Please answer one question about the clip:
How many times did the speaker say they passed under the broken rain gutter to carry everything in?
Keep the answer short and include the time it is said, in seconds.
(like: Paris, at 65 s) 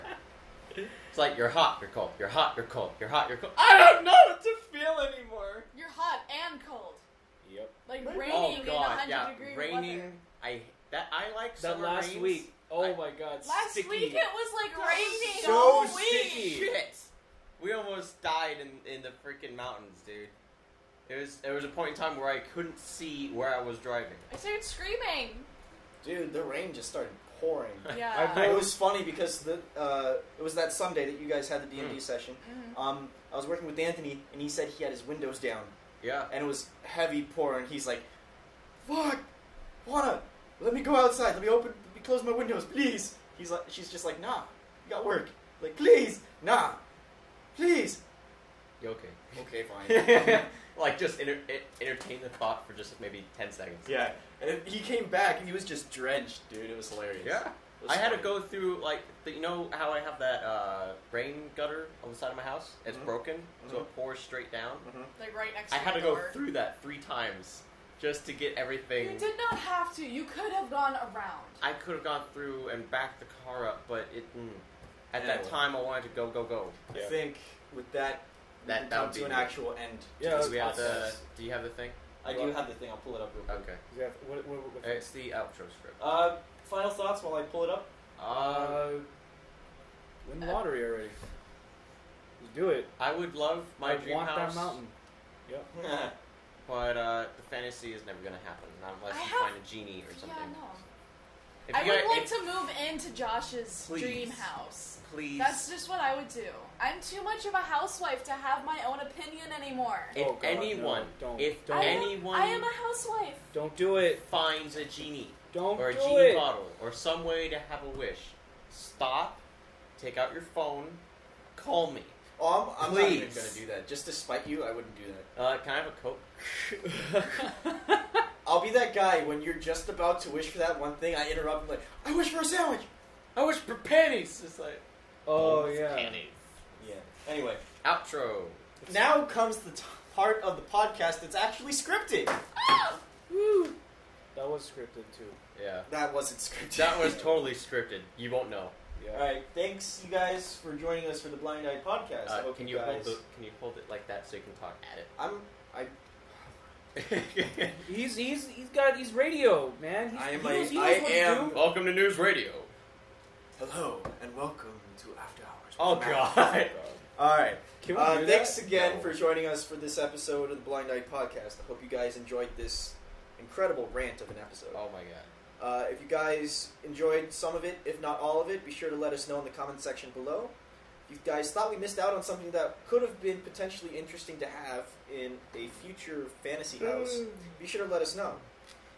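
3, at 66 s.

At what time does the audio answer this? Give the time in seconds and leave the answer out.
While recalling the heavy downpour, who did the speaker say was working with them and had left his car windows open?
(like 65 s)
33 s.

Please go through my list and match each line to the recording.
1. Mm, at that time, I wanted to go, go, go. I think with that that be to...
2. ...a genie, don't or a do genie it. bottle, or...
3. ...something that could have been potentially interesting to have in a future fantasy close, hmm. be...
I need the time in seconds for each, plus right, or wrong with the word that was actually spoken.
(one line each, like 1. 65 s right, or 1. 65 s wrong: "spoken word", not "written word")
1. 74 s right
2. 114 s right
3. 182 s wrong: "house", not "close".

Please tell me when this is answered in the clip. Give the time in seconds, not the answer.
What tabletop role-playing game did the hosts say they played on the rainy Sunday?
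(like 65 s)
31 s.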